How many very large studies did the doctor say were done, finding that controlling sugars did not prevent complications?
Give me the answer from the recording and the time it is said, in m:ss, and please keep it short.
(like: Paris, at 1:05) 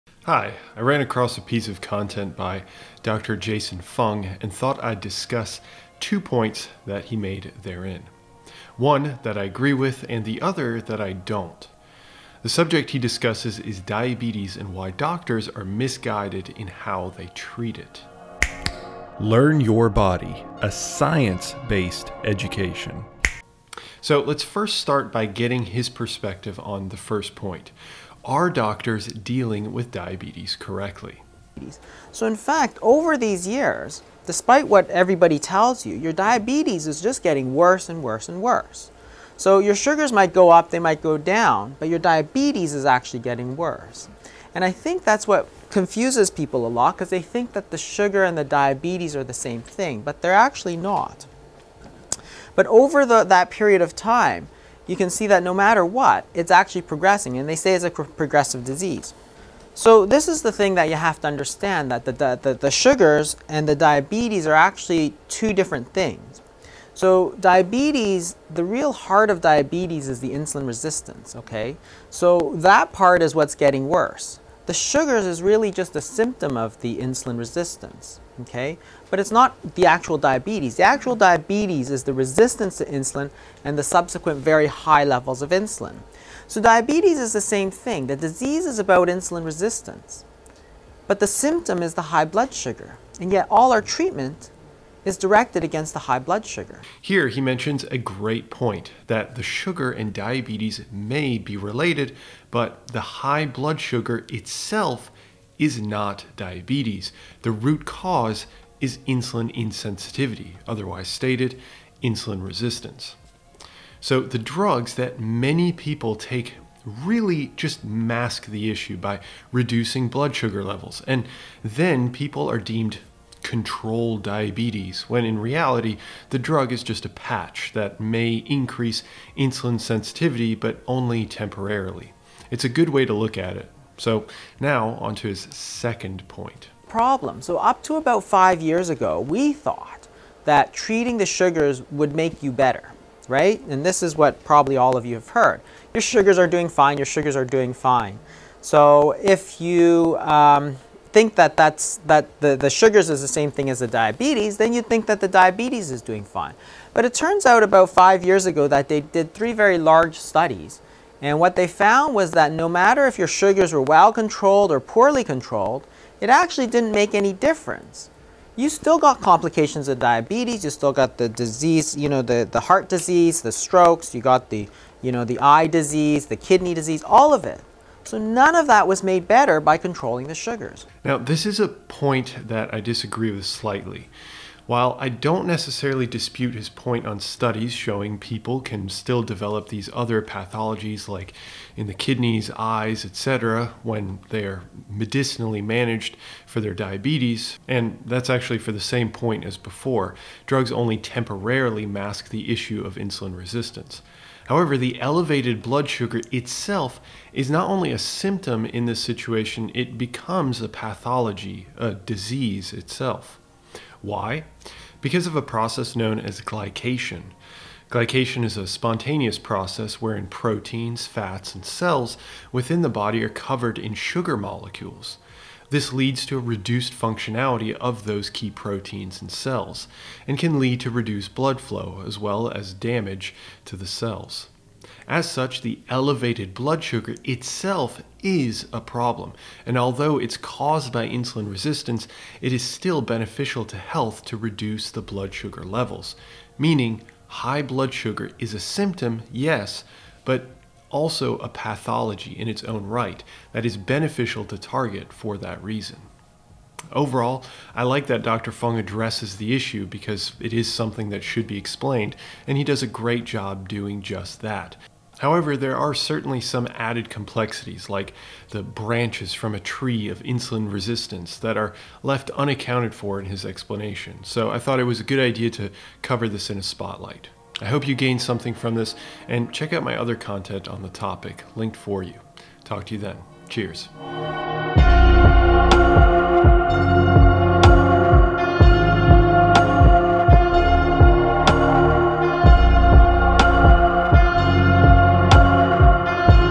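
3, at 2:39.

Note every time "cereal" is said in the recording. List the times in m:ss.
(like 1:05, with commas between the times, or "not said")
not said.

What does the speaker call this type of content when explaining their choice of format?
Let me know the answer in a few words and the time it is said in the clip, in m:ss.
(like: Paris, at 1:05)
a spotlight, at 4:36.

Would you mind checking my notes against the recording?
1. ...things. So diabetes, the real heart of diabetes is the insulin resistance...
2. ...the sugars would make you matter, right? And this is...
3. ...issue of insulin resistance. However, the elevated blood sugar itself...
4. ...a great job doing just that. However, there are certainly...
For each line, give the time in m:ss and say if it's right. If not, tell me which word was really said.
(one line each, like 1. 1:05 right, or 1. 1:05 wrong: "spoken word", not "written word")
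1. 1:05 right
2. 2:21 wrong: "better", not "matter"
3. 3:22 right
4. 4:22 right.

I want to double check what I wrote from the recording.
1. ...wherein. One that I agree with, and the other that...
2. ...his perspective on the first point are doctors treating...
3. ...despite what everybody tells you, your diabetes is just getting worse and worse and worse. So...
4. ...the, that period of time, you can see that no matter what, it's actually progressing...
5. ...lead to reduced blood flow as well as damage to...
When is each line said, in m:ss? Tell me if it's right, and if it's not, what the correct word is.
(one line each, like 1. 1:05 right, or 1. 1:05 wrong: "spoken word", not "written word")
1. 0:07 wrong: "therein", not "wherein"
2. 0:25 wrong: "dealing", not "treating"
3. 0:34 right
4. 0:53 right
5. 3:50 right.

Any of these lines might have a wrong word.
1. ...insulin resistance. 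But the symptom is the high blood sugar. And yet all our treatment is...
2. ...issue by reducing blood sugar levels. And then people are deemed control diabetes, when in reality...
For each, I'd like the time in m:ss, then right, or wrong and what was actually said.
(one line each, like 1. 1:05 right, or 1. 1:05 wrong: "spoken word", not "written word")
1. 1:29 right
2. 1:58 right.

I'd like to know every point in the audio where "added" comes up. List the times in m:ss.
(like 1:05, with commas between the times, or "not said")
4:26.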